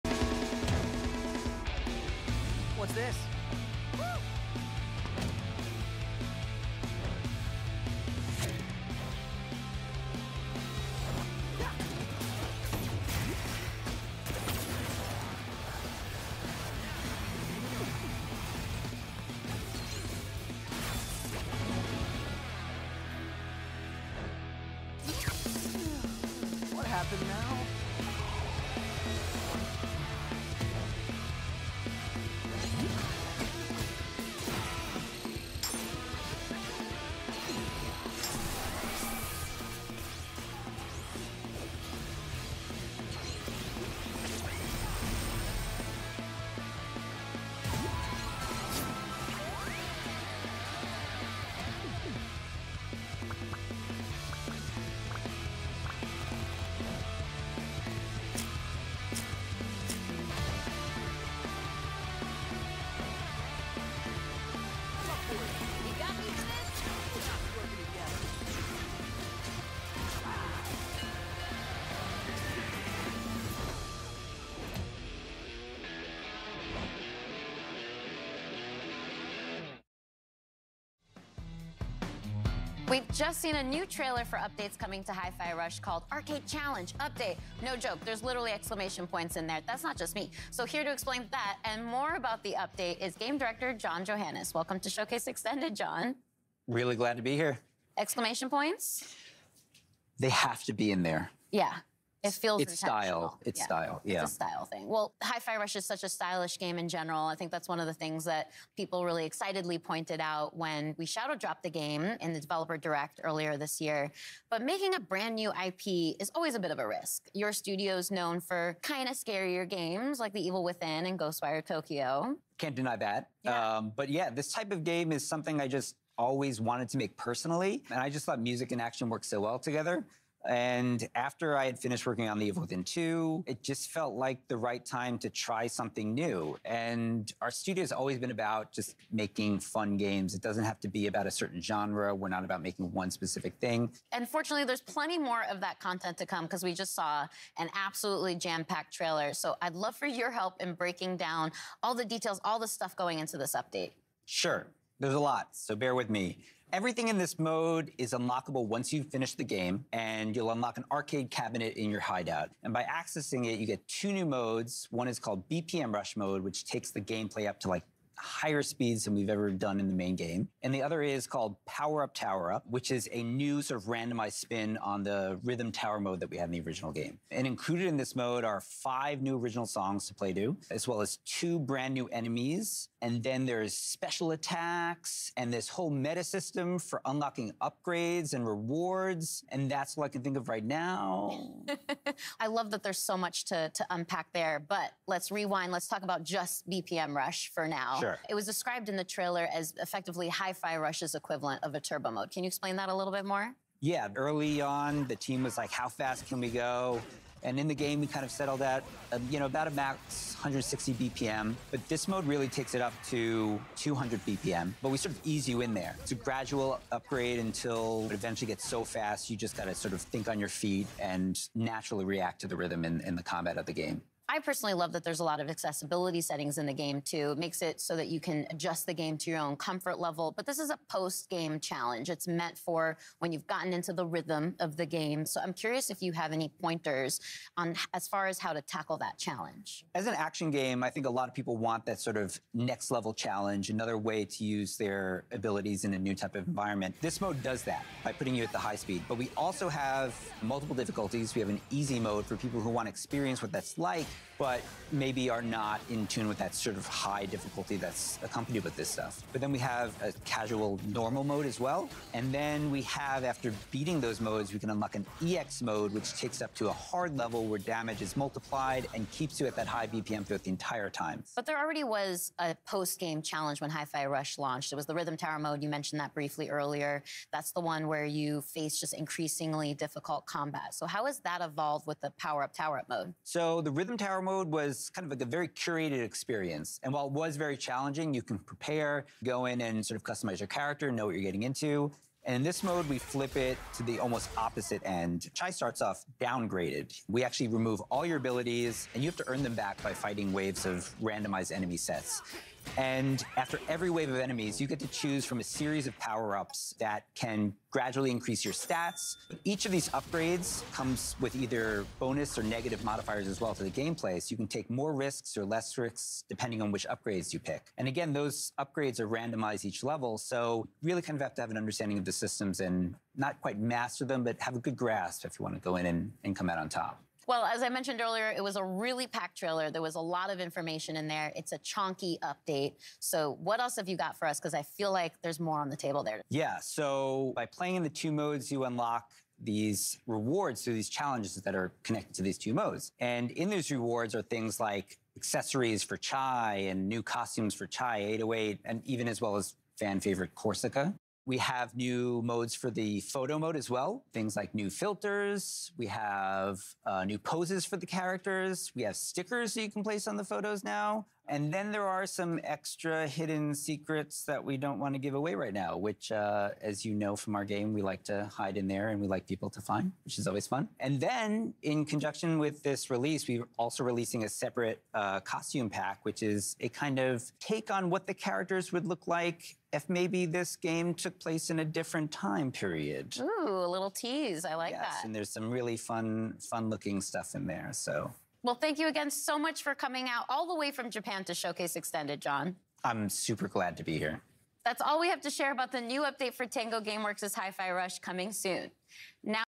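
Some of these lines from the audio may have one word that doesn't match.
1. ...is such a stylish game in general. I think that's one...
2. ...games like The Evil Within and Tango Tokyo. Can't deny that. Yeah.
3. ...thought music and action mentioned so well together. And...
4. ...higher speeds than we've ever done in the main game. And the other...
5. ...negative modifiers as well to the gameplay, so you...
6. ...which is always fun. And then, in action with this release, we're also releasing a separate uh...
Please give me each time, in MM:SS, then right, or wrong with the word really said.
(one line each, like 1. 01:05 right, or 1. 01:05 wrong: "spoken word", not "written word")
1. 01:45 right
2. 01:59 wrong: "Ghostwire", not "Tango"
3. 02:08 wrong: "worked", not "mentioned"
4. 02:48 right
5. 05:12 right
6. 06:10 wrong: "conjunction", not "action".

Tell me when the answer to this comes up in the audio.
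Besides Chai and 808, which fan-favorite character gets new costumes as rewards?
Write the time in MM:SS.
05:50.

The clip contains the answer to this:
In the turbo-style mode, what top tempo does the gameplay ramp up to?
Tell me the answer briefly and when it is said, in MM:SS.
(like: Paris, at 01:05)
200 BPM, at 03:33.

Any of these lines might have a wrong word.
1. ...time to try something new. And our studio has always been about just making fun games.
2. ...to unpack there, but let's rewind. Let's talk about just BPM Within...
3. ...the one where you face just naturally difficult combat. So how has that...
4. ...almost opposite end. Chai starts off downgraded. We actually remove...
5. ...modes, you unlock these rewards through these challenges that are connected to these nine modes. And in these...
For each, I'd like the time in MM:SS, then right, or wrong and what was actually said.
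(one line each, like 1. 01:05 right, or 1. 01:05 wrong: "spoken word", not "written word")
1. 02:14 right
2. 03:13 wrong: "Rush", not "Within"
3. 04:37 wrong: "increasingly", not "naturally"
4. 04:53 right
5. 05:38 wrong: "two", not "nine".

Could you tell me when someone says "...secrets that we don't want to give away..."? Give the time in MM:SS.
06:03.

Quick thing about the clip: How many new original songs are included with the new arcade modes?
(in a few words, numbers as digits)
5.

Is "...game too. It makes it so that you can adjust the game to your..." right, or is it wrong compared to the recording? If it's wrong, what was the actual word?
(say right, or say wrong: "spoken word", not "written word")
right.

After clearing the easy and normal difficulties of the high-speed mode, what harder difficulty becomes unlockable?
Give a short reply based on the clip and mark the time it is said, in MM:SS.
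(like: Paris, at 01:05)
EX mode, at 04:25.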